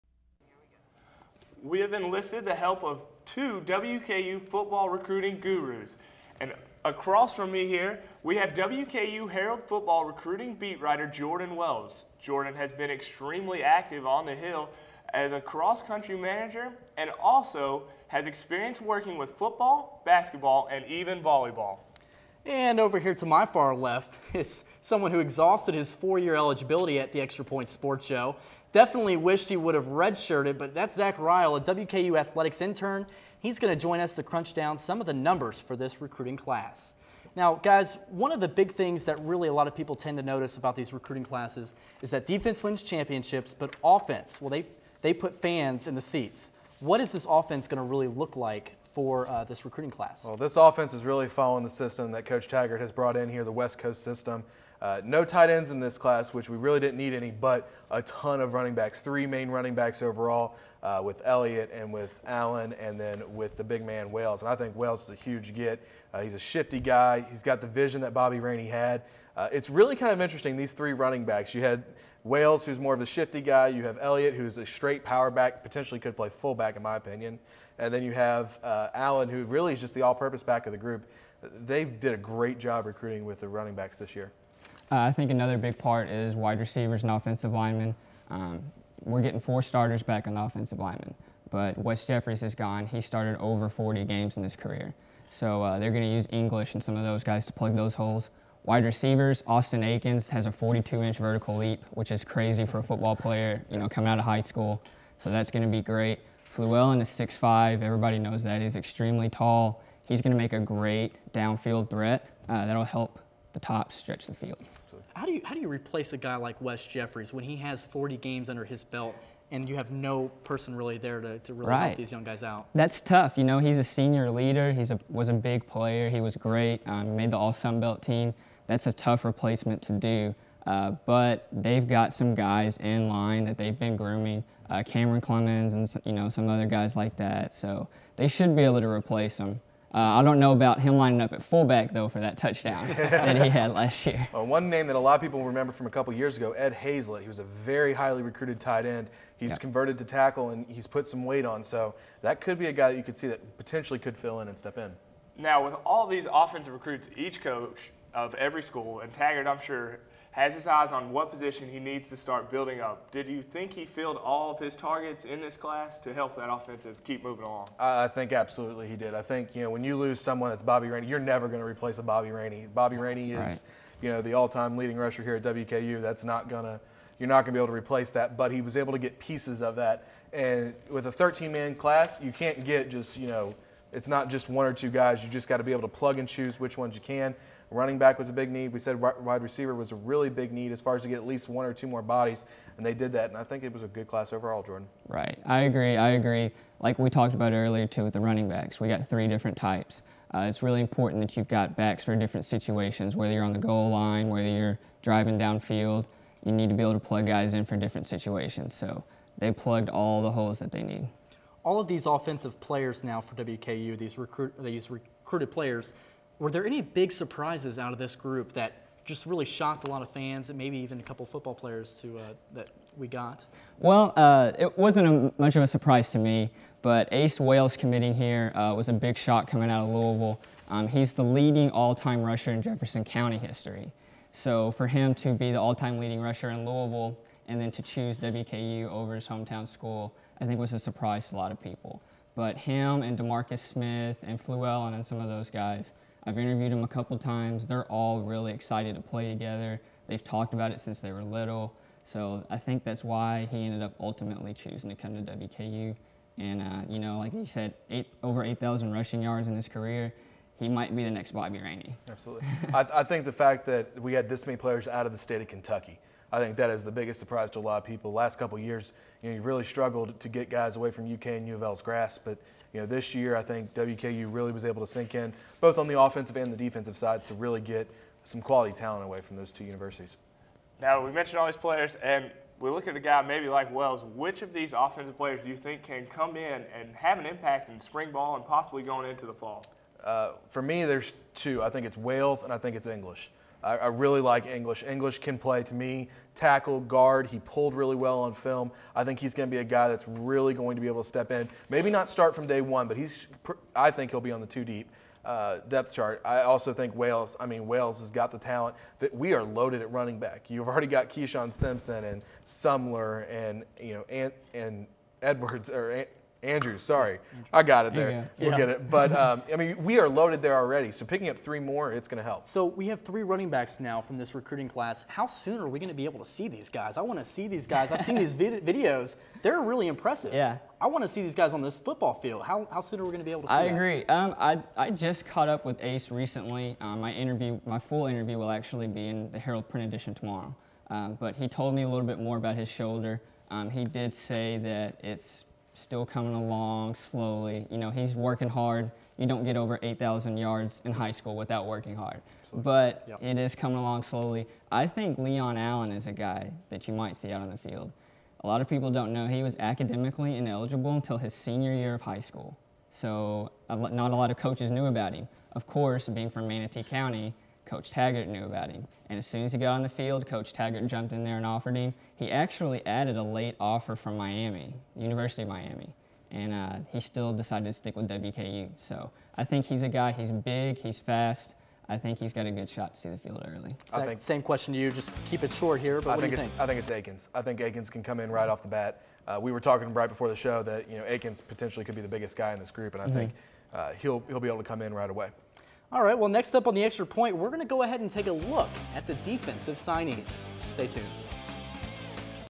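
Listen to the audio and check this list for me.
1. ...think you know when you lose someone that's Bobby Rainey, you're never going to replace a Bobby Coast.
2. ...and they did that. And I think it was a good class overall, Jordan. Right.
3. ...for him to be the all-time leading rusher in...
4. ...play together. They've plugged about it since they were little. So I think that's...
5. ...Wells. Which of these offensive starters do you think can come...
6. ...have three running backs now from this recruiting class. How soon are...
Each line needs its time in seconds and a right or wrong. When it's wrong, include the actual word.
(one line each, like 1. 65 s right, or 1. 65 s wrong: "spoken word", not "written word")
1. 169 s wrong: "Rainey", not "Coast"
2. 192 s right
3. 234 s right
4. 249 s wrong: "talked", not "plugged"
5. 283 s wrong: "players", not "starters"
6. 322 s right.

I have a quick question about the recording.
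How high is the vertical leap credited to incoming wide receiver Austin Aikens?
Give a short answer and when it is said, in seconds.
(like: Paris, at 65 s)
42 inches, at 100 s.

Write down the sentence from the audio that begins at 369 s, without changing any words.
And as soon as he got on the field, Coach Taggart jumped in there and offered him.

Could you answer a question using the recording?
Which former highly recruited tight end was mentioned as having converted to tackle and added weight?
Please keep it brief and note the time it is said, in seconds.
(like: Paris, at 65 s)
Ed Hazlett, at 146 s.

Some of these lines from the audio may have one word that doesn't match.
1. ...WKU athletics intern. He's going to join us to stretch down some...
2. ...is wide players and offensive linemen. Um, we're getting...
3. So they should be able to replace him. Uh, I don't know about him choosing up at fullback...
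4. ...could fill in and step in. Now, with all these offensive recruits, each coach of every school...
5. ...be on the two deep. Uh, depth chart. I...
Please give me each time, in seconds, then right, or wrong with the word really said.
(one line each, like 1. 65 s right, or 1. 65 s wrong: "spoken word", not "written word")
1. 31 s wrong: "crunch", not "stretch"
2. 86 s wrong: "receivers", not "players"
3. 137 s wrong: "lining", not "choosing"
4. 153 s right
5. 304 s right.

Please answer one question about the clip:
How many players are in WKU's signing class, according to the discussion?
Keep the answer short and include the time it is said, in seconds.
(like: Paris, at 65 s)
13, at 181 s.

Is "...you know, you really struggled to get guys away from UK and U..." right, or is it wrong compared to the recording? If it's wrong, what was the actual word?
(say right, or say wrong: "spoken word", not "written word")
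right.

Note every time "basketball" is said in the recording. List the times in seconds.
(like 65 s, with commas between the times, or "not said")
20 s.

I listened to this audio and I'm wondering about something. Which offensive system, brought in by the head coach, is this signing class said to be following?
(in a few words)
West Coast system.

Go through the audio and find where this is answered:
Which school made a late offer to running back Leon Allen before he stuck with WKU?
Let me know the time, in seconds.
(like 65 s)
374 s.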